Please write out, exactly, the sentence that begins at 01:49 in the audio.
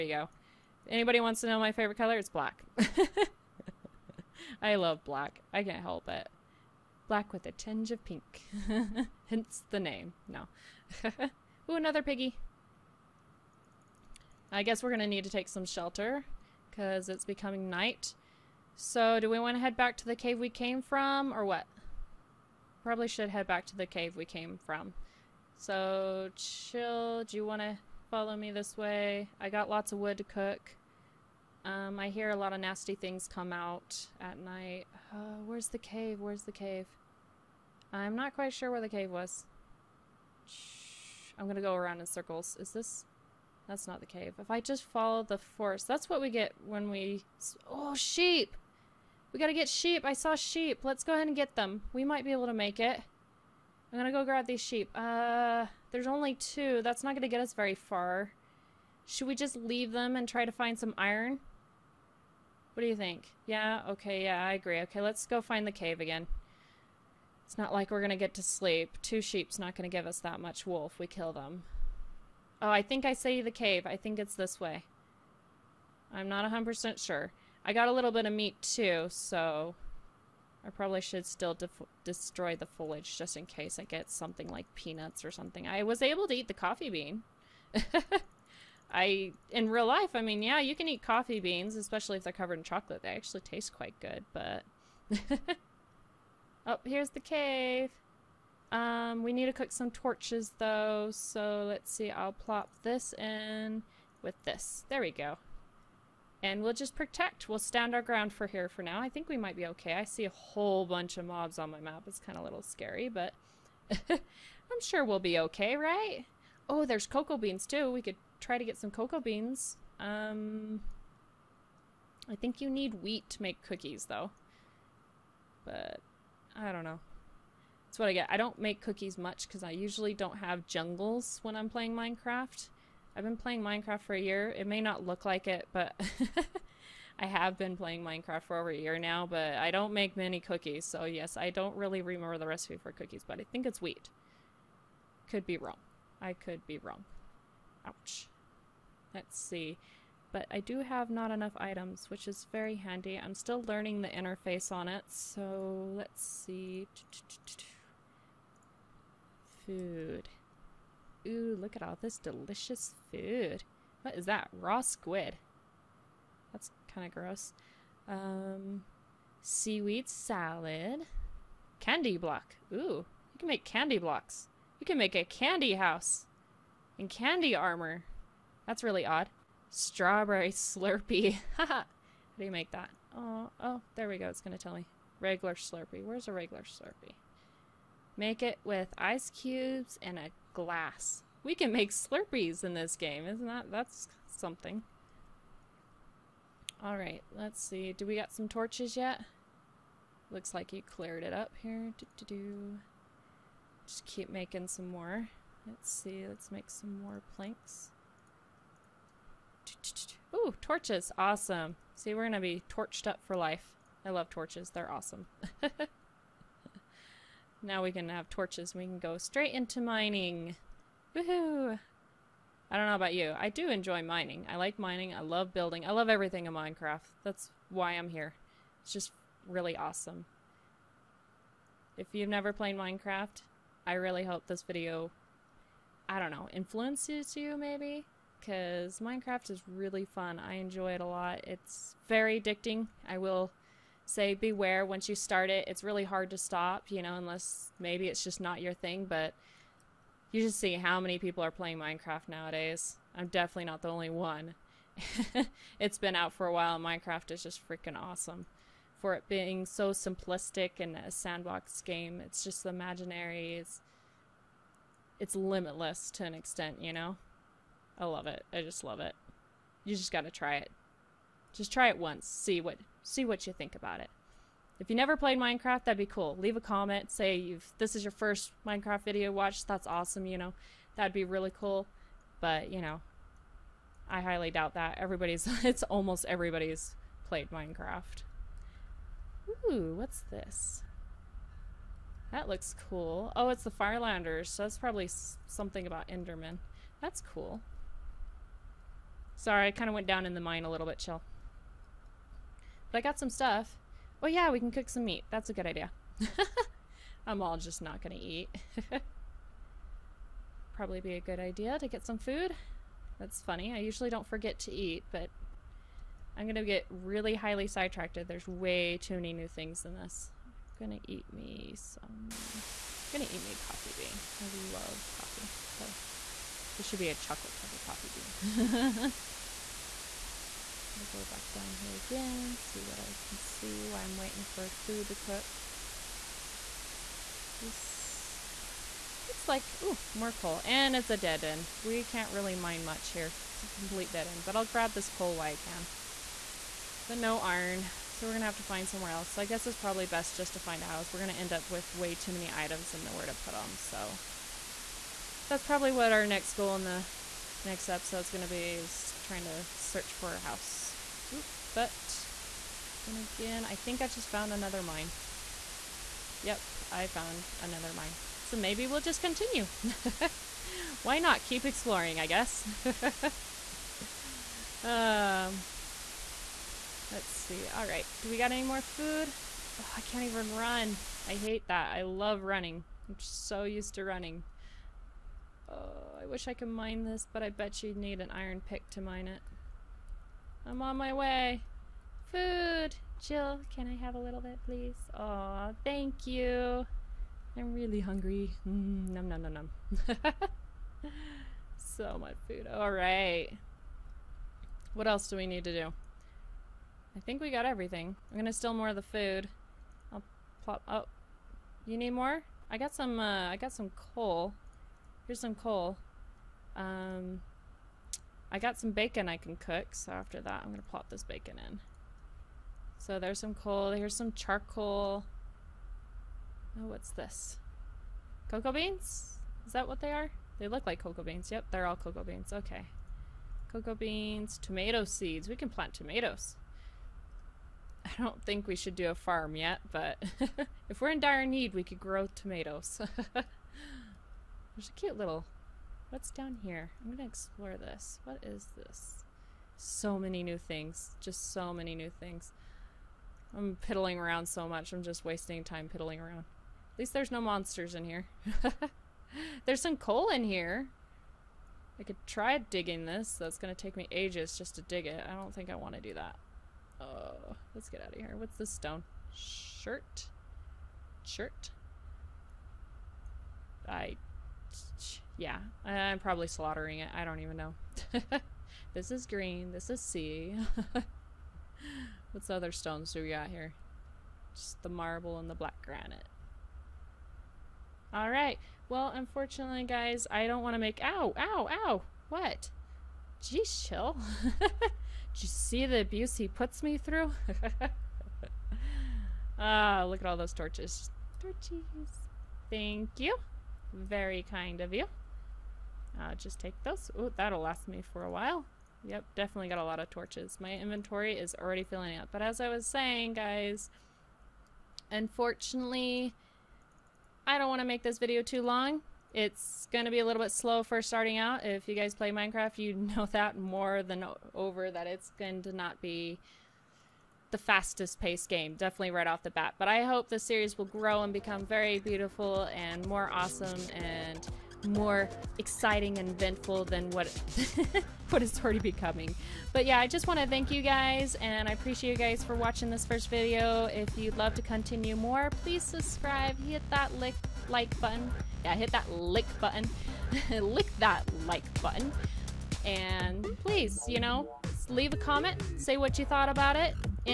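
I see a whole bunch of mobs on my map.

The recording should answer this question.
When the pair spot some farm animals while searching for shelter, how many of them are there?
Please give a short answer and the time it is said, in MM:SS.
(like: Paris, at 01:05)
2, at 00:55.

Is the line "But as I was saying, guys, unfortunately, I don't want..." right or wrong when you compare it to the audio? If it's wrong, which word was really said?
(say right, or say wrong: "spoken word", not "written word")
right.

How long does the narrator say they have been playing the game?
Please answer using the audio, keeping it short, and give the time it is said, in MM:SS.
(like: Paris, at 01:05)
Over a year, at 02:18.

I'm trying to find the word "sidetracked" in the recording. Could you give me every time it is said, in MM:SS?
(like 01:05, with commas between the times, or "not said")
05:17.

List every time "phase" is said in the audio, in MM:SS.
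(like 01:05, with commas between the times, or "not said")
not said.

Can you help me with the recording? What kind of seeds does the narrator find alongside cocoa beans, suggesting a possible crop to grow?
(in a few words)
Tomato seeds.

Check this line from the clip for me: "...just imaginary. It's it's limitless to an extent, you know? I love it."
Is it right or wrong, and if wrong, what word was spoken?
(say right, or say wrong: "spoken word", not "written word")
right.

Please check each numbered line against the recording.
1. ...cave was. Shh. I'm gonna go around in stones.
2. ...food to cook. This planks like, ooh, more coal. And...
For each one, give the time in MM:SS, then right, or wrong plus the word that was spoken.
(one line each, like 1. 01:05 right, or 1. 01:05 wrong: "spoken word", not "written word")
1. 00:38 wrong: "circles", not "stones"
2. 05:34 wrong: "looks", not "planks".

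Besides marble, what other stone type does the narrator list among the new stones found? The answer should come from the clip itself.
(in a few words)
Black granite.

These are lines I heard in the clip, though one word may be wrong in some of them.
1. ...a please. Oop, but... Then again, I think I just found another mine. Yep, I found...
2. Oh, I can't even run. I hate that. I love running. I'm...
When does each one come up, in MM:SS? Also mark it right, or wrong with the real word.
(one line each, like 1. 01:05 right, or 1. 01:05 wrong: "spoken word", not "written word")
1. 06:00 wrong: "house", not "please"
2. 06:19 right.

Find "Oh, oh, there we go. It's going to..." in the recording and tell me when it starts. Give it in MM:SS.
03:03.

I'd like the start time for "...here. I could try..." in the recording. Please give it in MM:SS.
07:40.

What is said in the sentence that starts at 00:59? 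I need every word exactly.
Should we just leave them and try to find some iron?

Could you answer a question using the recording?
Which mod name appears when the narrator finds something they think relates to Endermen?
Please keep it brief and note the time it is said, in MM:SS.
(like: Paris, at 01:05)
Farlanders, at 04:53.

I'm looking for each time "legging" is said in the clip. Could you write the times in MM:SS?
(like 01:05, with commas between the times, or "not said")
not said.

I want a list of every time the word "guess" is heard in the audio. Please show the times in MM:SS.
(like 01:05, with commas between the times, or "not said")
00:14, 05:49, 06:12.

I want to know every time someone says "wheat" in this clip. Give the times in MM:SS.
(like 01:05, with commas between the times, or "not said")
02:03, 02:23.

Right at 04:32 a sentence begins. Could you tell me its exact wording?
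See what see what you think about it.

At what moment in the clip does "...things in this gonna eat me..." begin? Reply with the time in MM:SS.
05:19.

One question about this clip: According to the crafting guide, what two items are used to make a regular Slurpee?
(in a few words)
Ice cubes and a glass.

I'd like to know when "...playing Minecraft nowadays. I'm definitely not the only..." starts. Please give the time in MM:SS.
04:11.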